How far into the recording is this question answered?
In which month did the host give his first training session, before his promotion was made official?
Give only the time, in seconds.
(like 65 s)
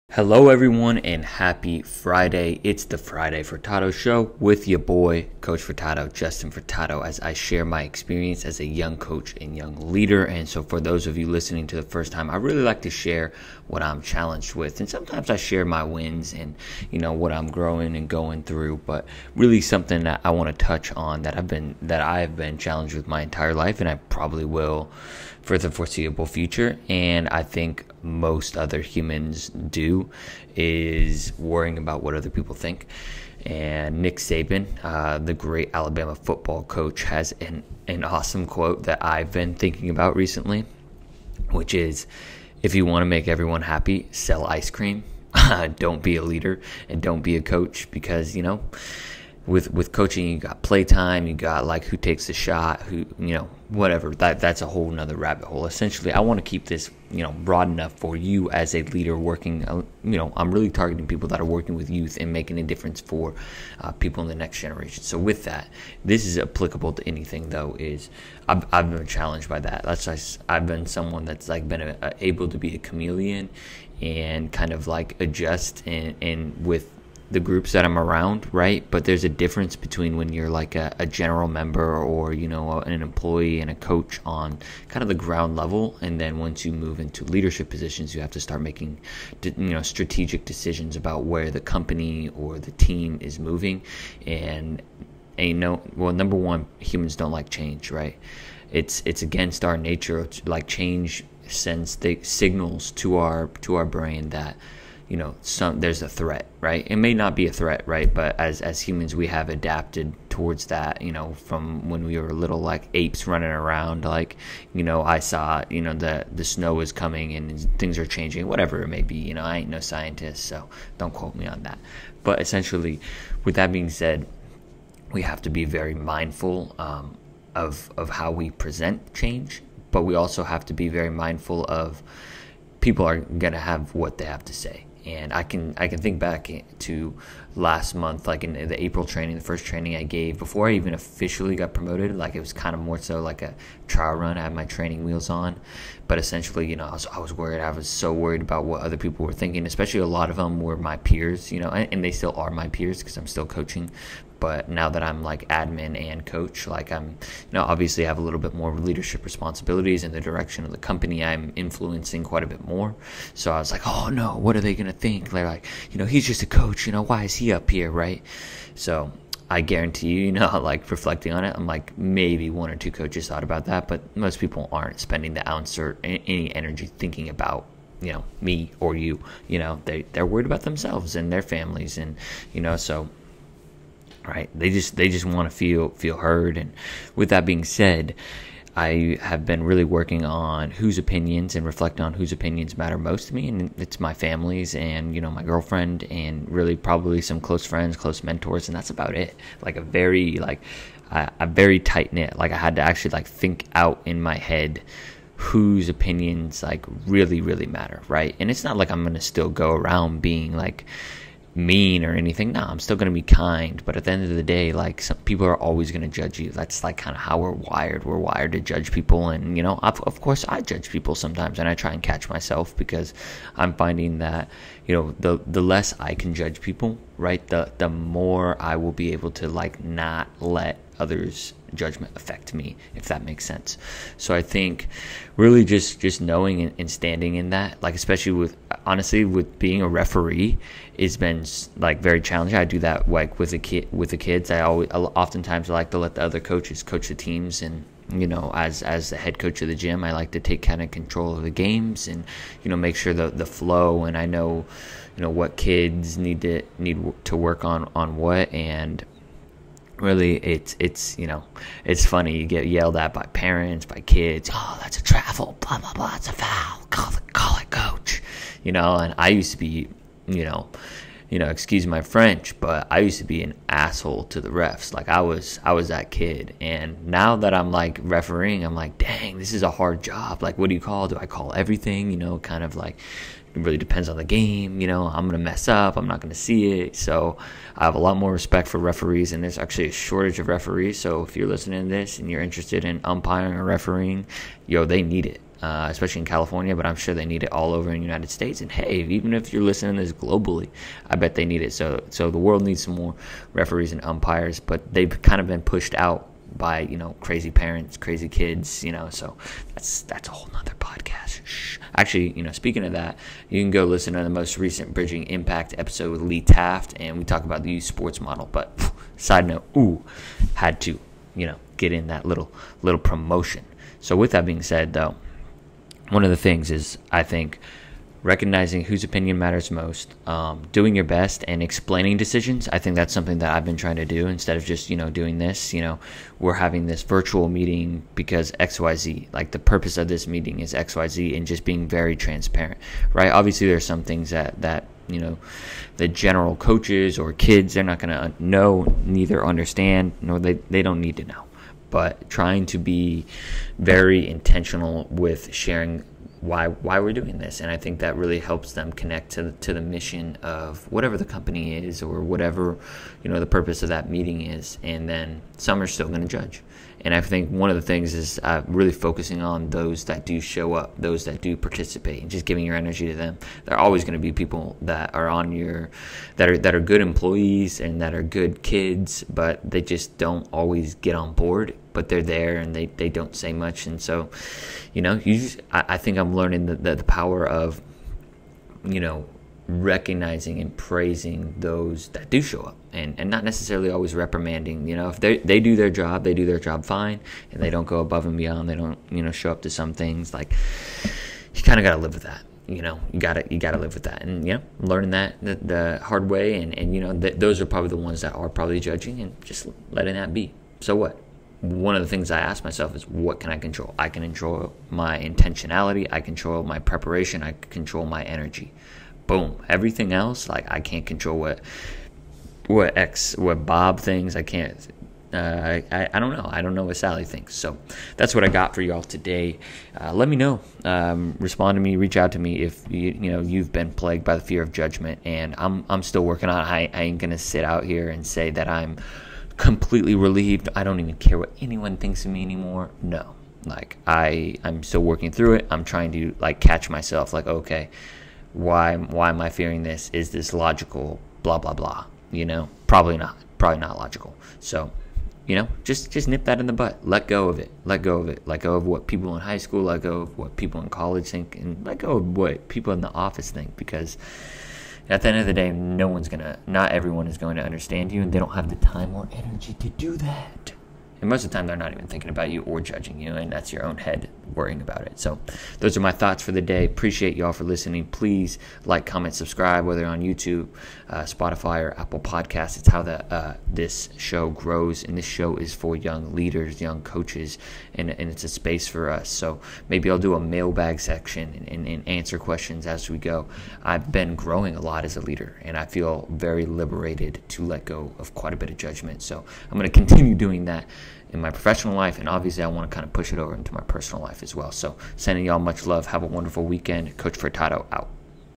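138 s.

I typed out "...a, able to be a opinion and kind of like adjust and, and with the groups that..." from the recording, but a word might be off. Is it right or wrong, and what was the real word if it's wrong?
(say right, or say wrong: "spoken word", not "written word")
wrong: "chameleon", not "opinion".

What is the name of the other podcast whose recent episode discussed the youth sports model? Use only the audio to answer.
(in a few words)
Bridging Impact.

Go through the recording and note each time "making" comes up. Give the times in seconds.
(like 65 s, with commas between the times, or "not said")
62 s, 88 s.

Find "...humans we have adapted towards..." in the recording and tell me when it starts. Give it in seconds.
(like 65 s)
108 s.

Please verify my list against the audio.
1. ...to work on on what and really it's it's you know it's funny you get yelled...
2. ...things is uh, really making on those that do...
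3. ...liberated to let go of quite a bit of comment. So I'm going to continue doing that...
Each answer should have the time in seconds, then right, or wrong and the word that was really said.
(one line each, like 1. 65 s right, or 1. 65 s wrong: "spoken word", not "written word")
1. 257 s right
2. 367 s wrong: "focusing", not "making"
3. 496 s wrong: "judgment", not "comment".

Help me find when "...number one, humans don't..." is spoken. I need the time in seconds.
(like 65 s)
96 s.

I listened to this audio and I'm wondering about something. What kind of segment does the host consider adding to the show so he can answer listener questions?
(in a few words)
mailbag section.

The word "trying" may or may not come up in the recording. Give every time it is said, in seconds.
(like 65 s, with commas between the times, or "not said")
333 s, 352 s, 445 s.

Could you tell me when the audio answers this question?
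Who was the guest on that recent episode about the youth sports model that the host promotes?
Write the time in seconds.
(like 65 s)
316 s.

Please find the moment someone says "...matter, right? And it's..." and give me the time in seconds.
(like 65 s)
207 s.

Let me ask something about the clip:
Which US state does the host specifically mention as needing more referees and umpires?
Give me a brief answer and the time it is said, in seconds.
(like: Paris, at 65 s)
California, at 296 s.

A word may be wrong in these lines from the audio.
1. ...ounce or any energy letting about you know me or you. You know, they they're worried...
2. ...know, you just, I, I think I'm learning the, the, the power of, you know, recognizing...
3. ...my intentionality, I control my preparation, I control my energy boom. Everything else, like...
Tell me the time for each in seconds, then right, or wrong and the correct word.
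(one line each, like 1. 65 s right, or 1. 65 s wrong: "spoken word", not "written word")
1. 175 s wrong: "thinking", not "letting"
2. 385 s right
3. 414 s right.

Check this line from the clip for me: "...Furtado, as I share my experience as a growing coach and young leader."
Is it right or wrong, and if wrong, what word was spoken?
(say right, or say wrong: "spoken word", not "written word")
wrong: "young", not "growing".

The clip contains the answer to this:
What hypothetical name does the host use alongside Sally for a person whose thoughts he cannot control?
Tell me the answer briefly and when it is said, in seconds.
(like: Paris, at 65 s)
Bob, at 423 s.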